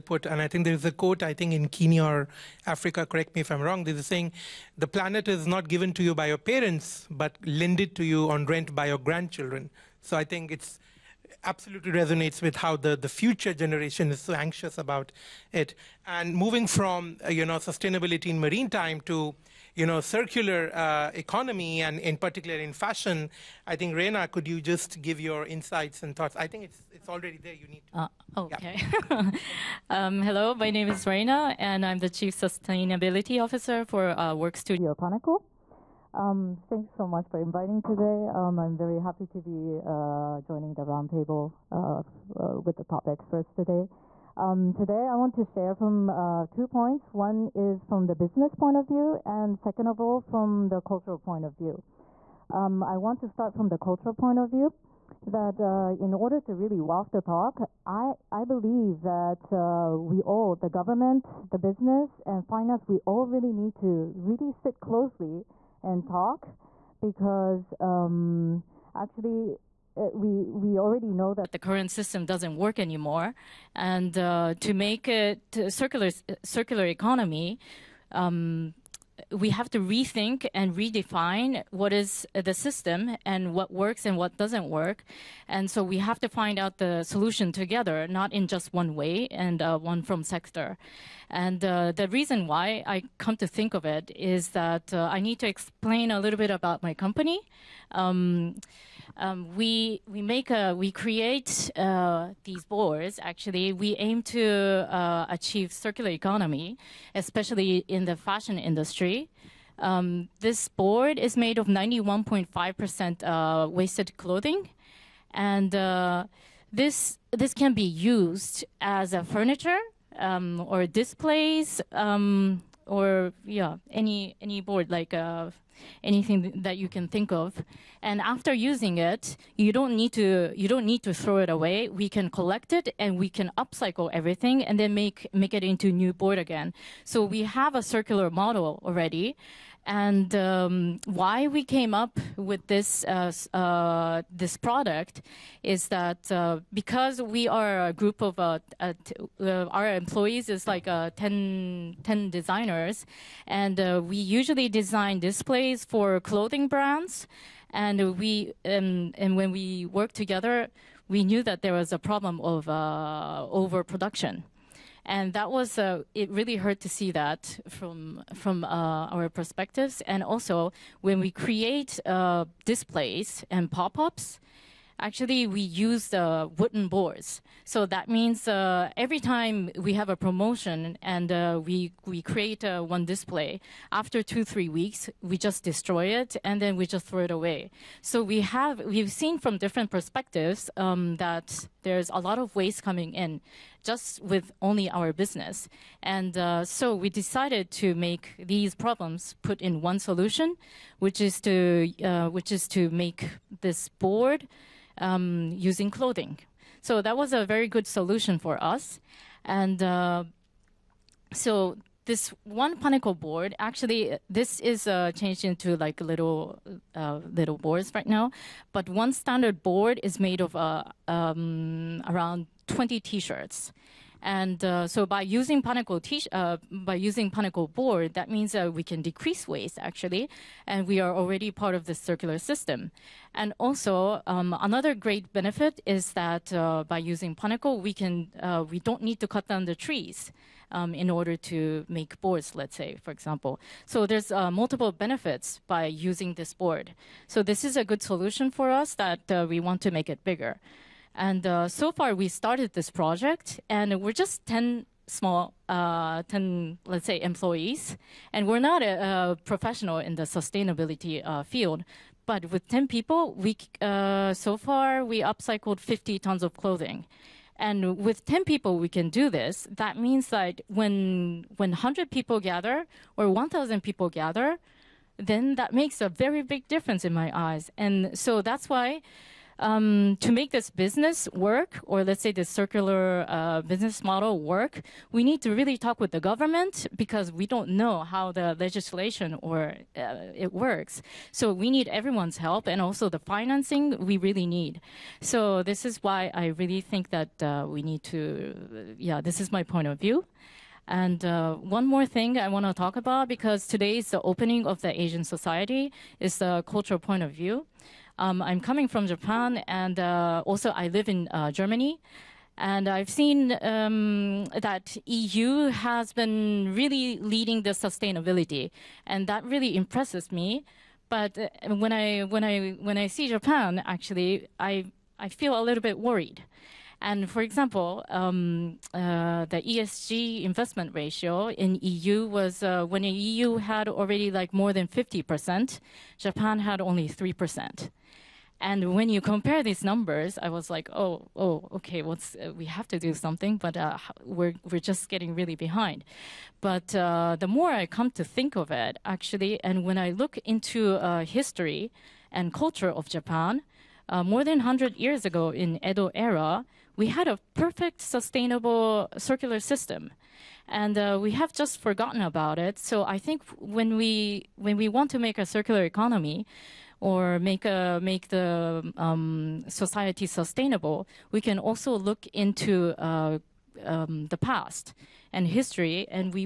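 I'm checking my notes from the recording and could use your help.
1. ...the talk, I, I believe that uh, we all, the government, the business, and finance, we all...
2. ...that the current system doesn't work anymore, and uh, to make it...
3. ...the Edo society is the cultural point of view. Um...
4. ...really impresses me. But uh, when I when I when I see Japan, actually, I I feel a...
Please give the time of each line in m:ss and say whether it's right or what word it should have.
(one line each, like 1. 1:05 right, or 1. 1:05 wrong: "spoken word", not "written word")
1. 0:57 right
2. 1:11 right
3. 5:04 wrong: "Asian", not "Edo"
4. 5:19 right.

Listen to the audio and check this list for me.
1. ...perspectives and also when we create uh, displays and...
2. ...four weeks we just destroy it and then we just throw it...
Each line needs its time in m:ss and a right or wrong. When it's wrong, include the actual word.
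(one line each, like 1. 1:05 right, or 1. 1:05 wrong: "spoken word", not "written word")
1. 2:49 right
2. 3:04 wrong: "three", not "four".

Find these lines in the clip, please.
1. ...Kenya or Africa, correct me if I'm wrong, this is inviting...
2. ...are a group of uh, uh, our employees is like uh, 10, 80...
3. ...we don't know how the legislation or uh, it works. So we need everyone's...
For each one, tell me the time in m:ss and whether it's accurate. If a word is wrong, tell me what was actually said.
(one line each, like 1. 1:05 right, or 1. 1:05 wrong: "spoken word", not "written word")
1. 0:01 wrong: "saying", not "inviting"
2. 2:27 wrong: "10", not "80"
3. 4:47 right.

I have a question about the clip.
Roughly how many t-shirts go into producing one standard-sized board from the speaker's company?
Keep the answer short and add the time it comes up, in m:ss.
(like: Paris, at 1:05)
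20, at 3:42.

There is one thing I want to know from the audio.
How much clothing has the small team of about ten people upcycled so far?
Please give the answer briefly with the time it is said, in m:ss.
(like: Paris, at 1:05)
50 tons, at 4:25.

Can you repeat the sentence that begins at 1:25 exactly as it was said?
And so we have to find out the solution together, not in just one way and uh, one from sector.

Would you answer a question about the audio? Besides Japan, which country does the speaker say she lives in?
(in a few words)
Germany.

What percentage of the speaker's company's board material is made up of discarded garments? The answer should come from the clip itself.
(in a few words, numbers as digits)
91.5%.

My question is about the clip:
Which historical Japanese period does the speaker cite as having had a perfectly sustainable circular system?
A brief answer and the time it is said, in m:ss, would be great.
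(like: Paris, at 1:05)
Edo era, at 5:55.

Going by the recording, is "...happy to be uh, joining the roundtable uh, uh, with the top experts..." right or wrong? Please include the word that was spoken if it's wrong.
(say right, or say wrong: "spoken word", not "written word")
right.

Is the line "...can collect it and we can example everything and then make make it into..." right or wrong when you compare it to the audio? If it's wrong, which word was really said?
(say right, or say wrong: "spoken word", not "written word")
wrong: "upcycle", not "example".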